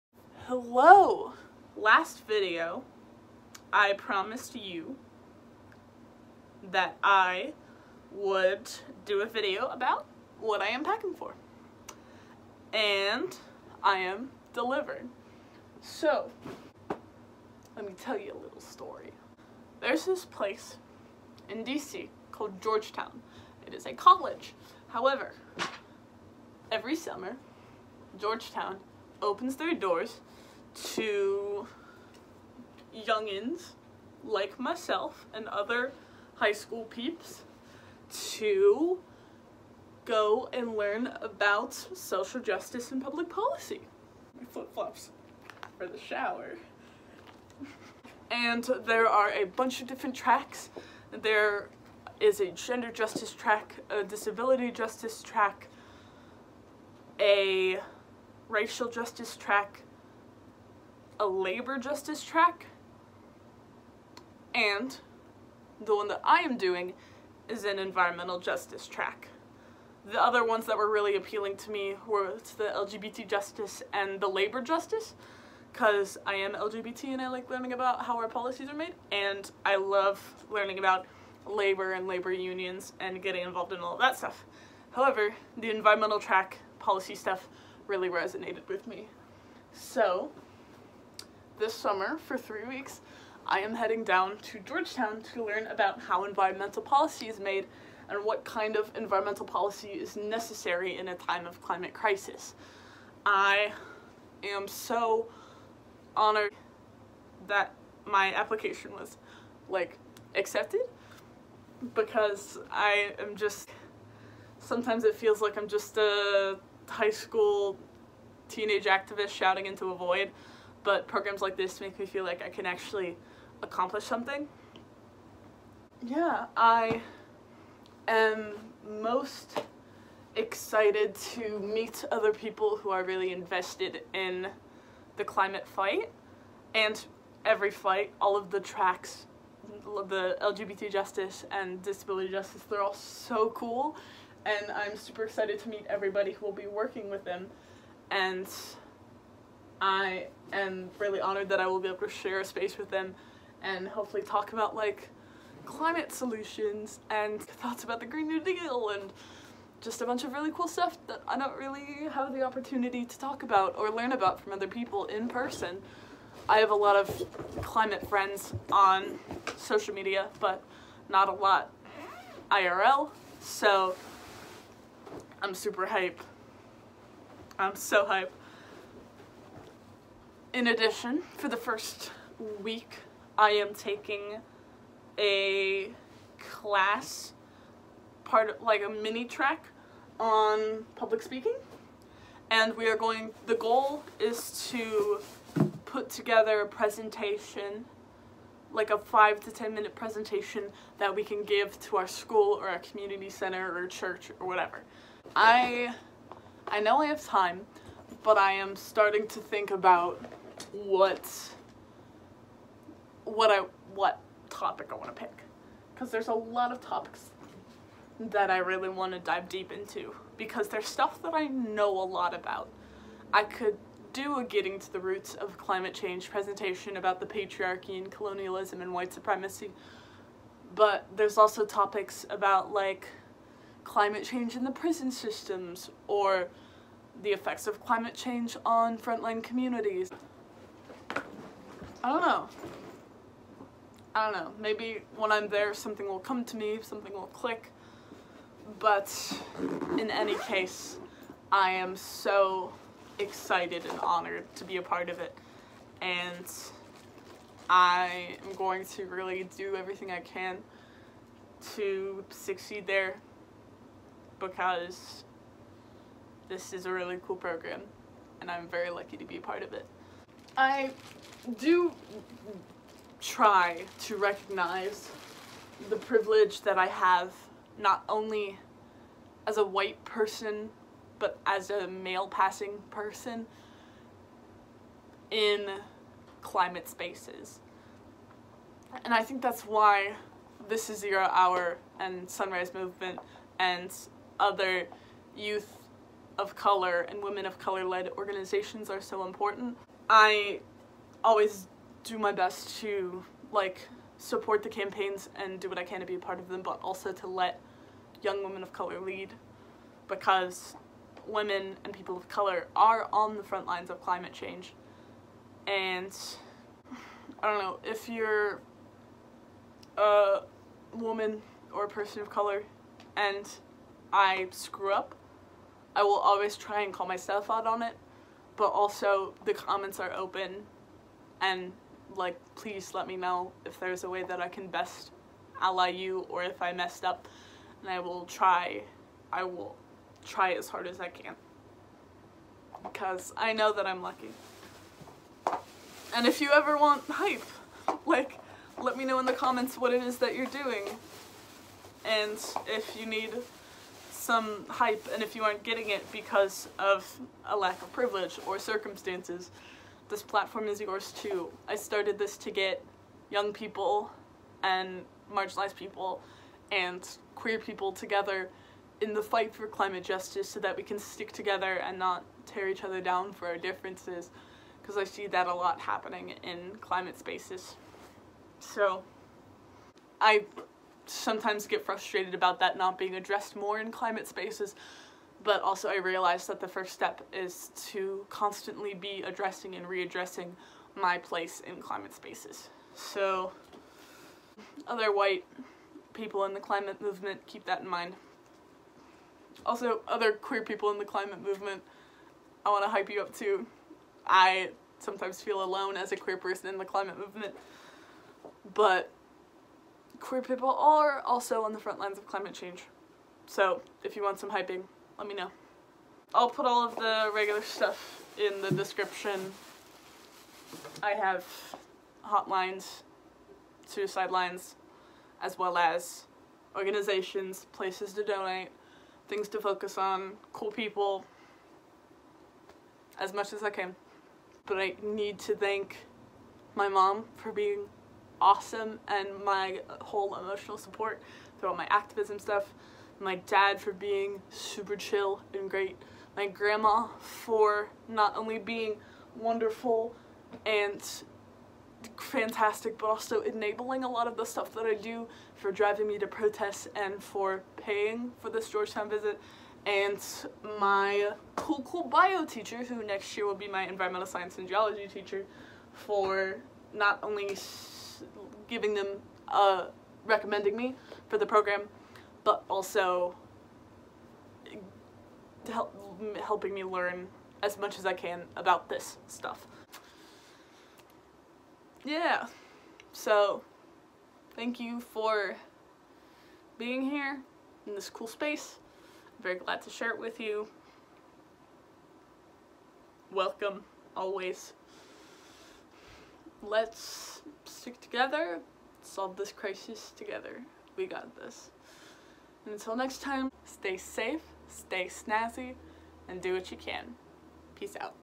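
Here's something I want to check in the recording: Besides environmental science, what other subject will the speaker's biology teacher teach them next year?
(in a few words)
Geology.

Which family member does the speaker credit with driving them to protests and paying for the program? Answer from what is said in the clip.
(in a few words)
Grandma.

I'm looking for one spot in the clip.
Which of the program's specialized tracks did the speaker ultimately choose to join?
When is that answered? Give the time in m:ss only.
1:07.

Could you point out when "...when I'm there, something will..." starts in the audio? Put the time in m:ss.
4:05.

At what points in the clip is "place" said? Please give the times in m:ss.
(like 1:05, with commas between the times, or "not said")
0:20, 6:31, 7:07.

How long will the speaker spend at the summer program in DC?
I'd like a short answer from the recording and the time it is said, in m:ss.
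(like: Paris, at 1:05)
3 weeks, at 1:32.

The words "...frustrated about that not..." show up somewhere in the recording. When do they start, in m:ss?
6:21.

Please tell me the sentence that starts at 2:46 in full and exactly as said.
I have a lot of climate friends on social media, but not a lot IRL, so I'm super hype.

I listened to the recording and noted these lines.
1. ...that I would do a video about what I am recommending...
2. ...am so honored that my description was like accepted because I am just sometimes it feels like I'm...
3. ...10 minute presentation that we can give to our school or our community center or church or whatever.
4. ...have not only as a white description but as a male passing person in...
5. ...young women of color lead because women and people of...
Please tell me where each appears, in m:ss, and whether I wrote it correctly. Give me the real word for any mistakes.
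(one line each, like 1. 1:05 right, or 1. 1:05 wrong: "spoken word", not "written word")
1. 0:06 wrong: "packing", not "recommending"
2. 1:44 wrong: "application", not "description"
3. 3:19 right
4. 4:36 wrong: "person", not "description"
5. 5:08 right.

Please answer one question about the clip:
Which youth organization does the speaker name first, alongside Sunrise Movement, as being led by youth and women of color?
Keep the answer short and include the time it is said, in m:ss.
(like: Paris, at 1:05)
This Is Zero Hour, at 4:50.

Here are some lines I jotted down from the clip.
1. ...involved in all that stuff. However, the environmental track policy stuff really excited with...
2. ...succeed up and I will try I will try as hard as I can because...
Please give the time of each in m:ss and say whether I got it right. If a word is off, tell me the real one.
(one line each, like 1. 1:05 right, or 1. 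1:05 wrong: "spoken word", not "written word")
1. 1:23 wrong: "resonated", not "excited"
2. 5:36 wrong: "messed", not "succeed".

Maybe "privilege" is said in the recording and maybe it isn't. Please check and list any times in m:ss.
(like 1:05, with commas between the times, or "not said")
4:35, 5:57.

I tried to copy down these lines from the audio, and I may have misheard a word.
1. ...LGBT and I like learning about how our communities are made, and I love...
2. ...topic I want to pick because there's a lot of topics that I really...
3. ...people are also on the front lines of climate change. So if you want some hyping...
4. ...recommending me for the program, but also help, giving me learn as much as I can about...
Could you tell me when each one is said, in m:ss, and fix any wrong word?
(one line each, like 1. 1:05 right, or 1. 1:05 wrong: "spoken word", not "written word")
1. 1:16 wrong: "policies", not "communities"
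2. 3:34 right
3. 6:50 right
4. 7:50 wrong: "helping", not "giving".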